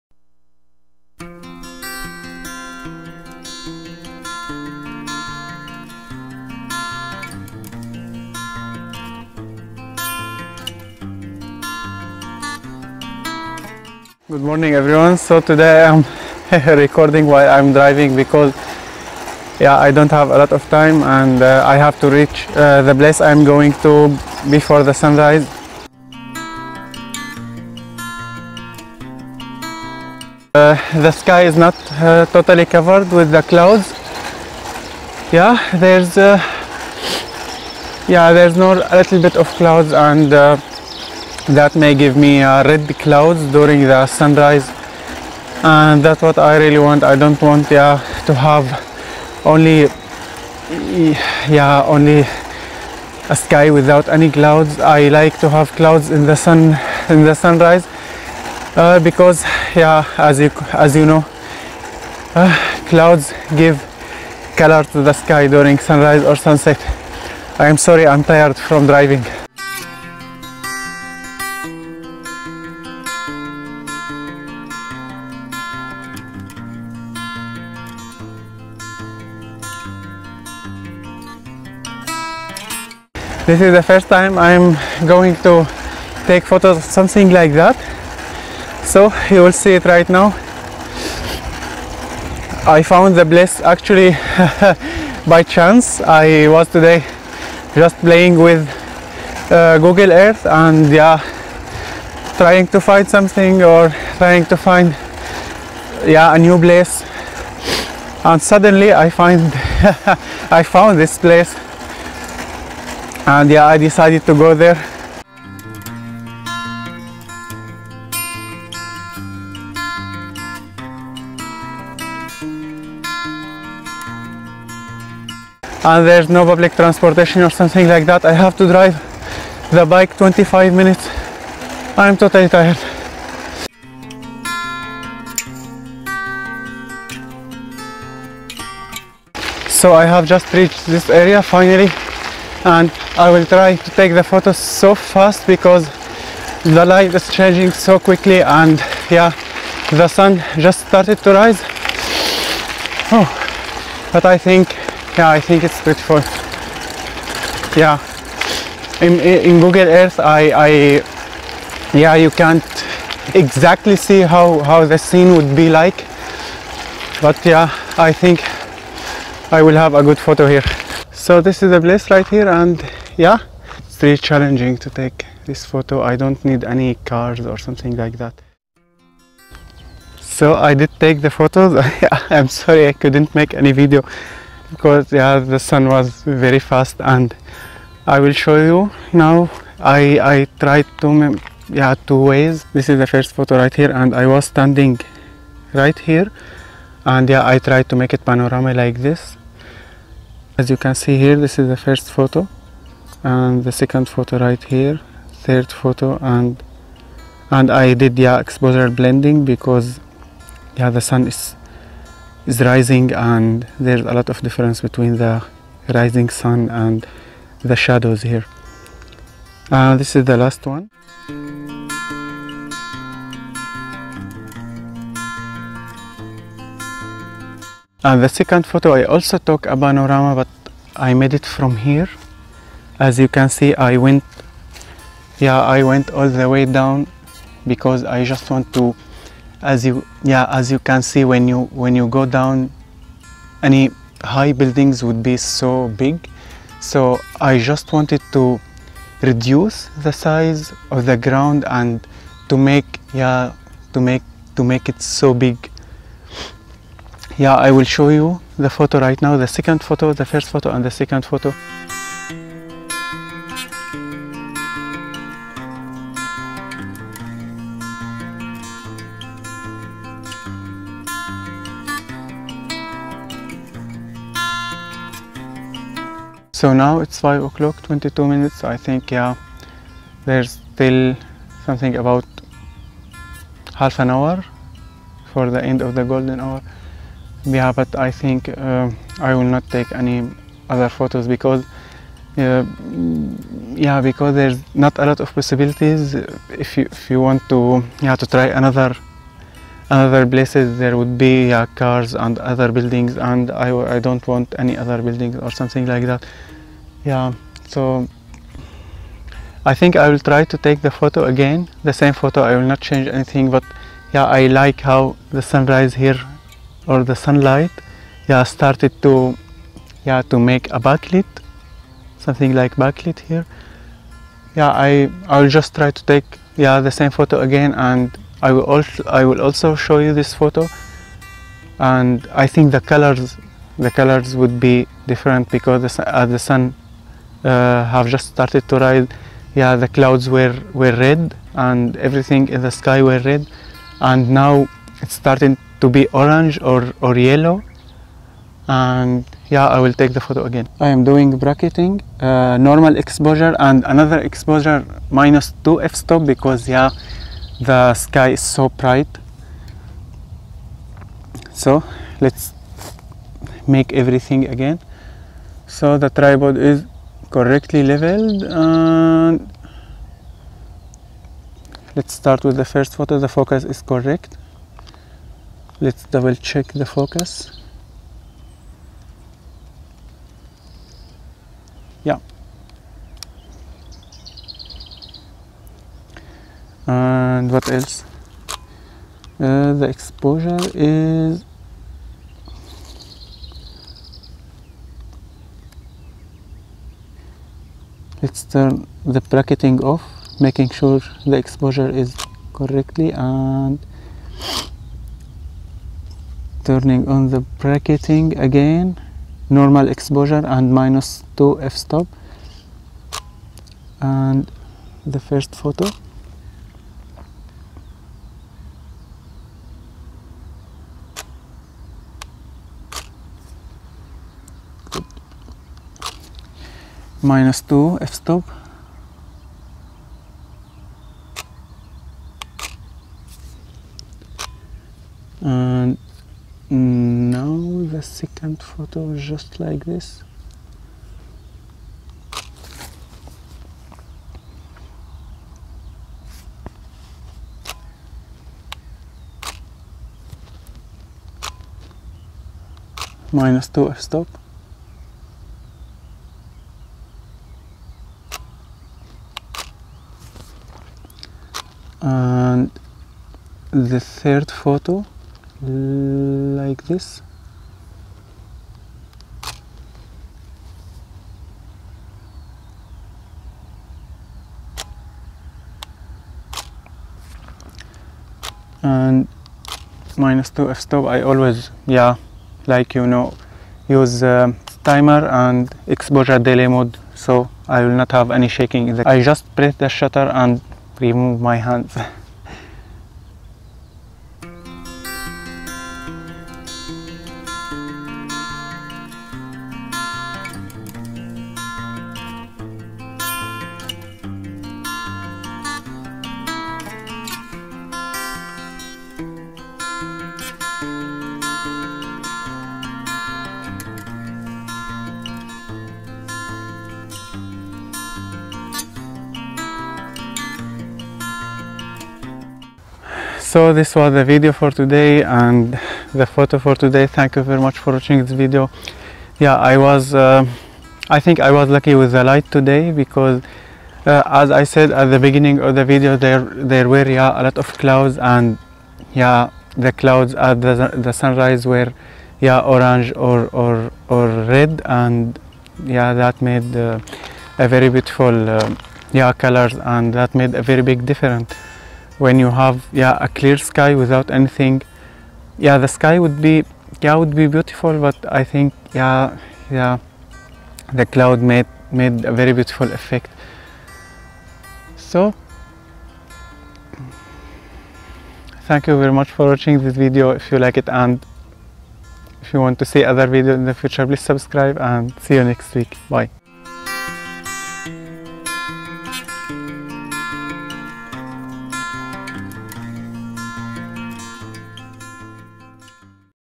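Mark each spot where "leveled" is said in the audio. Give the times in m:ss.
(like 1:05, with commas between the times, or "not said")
6:07.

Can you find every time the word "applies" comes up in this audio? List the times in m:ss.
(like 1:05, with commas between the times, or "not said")
not said.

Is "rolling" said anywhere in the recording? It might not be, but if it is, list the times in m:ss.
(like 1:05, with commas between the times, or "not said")
not said.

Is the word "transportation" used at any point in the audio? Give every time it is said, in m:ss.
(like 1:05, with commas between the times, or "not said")
2:06.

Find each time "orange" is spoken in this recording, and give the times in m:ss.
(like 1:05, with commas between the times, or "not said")
5:46, 9:02.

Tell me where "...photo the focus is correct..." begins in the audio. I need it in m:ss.
6:12.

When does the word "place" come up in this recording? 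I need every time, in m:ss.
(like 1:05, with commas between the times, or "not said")
0:22, 1:33, 1:46, 1:51, 2:51, 5:00.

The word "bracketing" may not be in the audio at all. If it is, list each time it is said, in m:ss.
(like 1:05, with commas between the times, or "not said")
5:51, 6:39, 6:47.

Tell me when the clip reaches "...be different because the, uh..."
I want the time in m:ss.
5:34.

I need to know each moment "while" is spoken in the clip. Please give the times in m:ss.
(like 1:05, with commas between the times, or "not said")
0:17.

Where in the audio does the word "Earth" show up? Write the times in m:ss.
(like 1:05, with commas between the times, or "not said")
1:40, 2:39.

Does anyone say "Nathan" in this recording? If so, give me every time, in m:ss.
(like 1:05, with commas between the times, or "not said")
not said.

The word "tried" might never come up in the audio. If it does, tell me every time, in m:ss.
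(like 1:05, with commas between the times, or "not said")
3:10, 3:17.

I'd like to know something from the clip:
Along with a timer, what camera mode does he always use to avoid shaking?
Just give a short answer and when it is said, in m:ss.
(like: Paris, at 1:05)
exposure delay mode, at 8:05.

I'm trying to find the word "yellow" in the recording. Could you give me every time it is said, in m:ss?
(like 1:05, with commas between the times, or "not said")
5:47.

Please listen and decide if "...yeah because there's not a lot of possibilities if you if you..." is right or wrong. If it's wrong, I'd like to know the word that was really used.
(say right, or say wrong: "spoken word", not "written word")
right.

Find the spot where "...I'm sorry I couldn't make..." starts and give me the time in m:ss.
3:02.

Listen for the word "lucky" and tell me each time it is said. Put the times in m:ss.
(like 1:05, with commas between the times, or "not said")
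8:51.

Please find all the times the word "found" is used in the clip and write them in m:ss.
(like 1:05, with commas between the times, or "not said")
1:32, 1:50.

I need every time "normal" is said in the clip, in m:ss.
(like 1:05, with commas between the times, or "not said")
5:52, 6:49.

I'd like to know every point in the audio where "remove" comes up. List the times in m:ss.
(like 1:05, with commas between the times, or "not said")
8:10.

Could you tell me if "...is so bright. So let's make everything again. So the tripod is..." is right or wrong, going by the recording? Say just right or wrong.
right.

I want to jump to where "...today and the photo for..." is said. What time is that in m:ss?
8:44.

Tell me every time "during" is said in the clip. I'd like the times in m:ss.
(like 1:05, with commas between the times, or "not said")
0:43, 1:05.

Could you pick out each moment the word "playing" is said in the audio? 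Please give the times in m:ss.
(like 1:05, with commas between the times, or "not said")
1:37.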